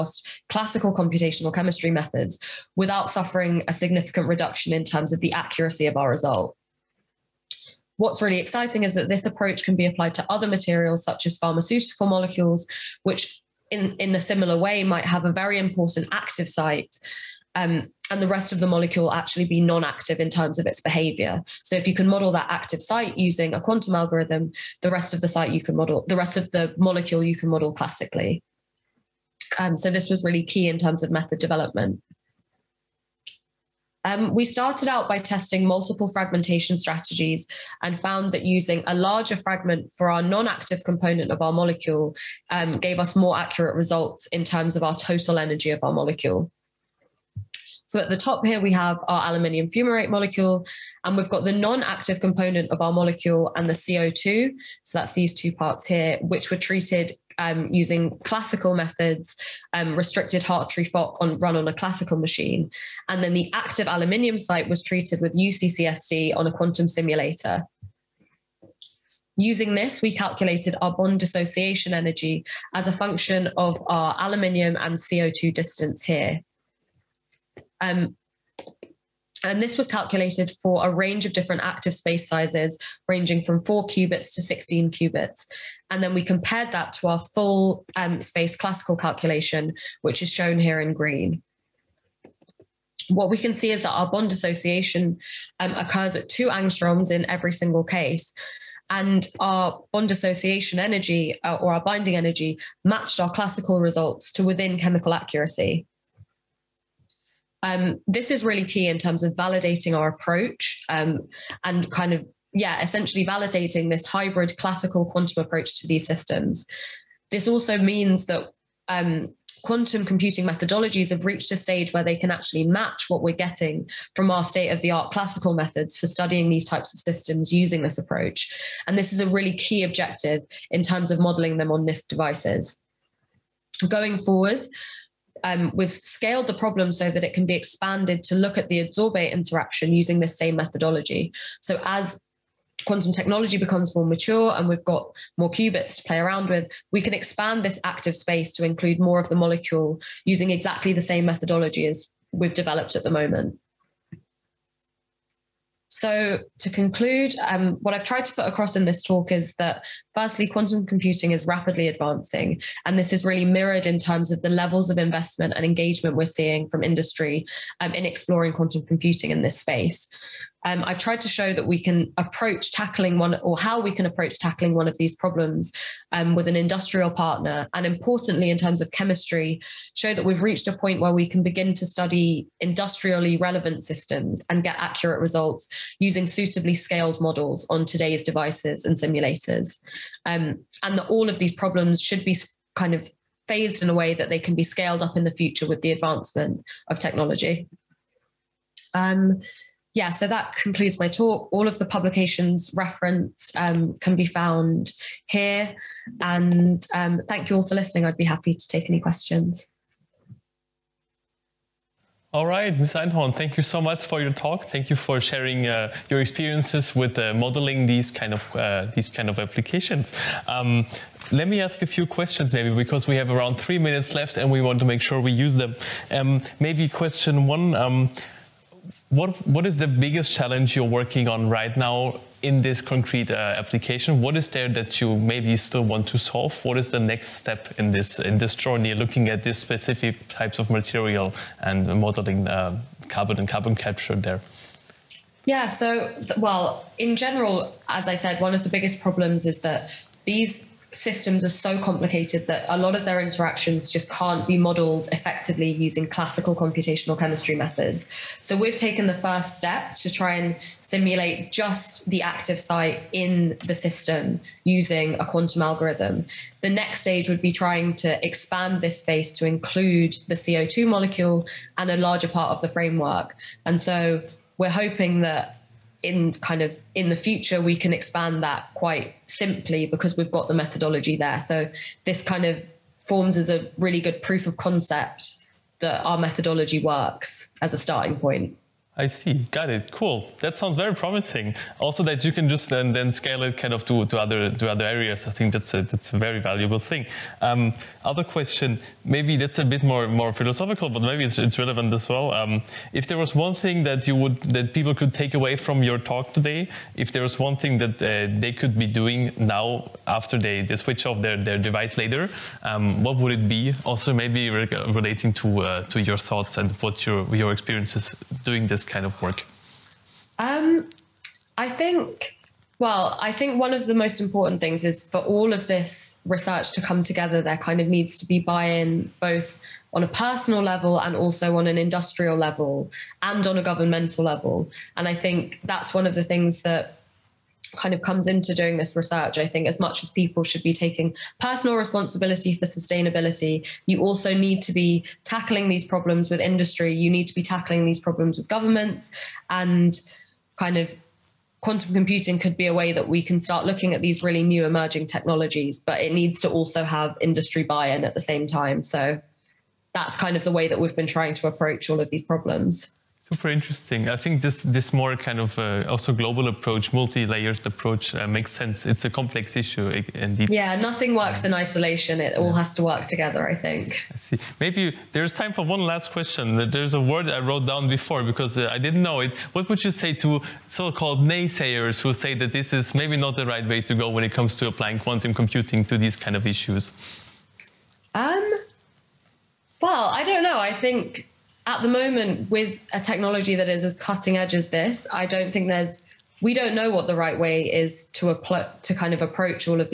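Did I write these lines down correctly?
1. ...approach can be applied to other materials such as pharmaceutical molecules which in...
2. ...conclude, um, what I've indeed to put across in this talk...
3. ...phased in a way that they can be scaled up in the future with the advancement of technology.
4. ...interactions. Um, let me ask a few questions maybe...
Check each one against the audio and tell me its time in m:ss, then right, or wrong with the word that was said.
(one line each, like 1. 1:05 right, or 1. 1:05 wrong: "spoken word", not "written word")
1. 0:09 right
2. 2:36 wrong: "tried", not "indeed"
3. 3:13 right
4. 3:39 wrong: "applications", not "interactions".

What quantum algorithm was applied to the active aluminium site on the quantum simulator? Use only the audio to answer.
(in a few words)
UCCSD.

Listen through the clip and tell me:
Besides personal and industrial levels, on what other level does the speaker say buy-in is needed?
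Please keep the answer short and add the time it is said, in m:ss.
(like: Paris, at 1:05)
governmental level, at 5:33.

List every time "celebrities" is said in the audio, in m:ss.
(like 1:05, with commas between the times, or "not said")
not said.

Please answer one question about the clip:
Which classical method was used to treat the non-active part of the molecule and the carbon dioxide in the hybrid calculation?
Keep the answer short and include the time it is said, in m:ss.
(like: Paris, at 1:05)
restricted Hartree-Fock, at 0:59.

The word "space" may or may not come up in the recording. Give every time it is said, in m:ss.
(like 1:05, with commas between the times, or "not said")
1:21, 1:28, 2:28, 2:49, 4:29.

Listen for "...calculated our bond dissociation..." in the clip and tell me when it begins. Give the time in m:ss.
1:10.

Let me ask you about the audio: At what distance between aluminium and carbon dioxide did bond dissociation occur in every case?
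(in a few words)
2 angstroms.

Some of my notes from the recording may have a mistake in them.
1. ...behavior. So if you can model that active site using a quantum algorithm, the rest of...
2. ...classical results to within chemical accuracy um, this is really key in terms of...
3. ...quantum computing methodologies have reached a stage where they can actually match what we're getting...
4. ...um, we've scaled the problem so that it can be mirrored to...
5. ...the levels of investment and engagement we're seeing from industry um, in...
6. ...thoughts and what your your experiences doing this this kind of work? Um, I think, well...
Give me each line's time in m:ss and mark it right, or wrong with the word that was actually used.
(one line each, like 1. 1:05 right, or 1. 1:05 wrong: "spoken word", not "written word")
1. 0:20 right
2. 1:43 right
3. 1:59 right
4. 2:15 wrong: "expanded", not "mirrored"
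5. 2:44 right
6. 5:16 right.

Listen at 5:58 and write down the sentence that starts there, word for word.
So that's kind of the way that we've been trying to approach all of these problems.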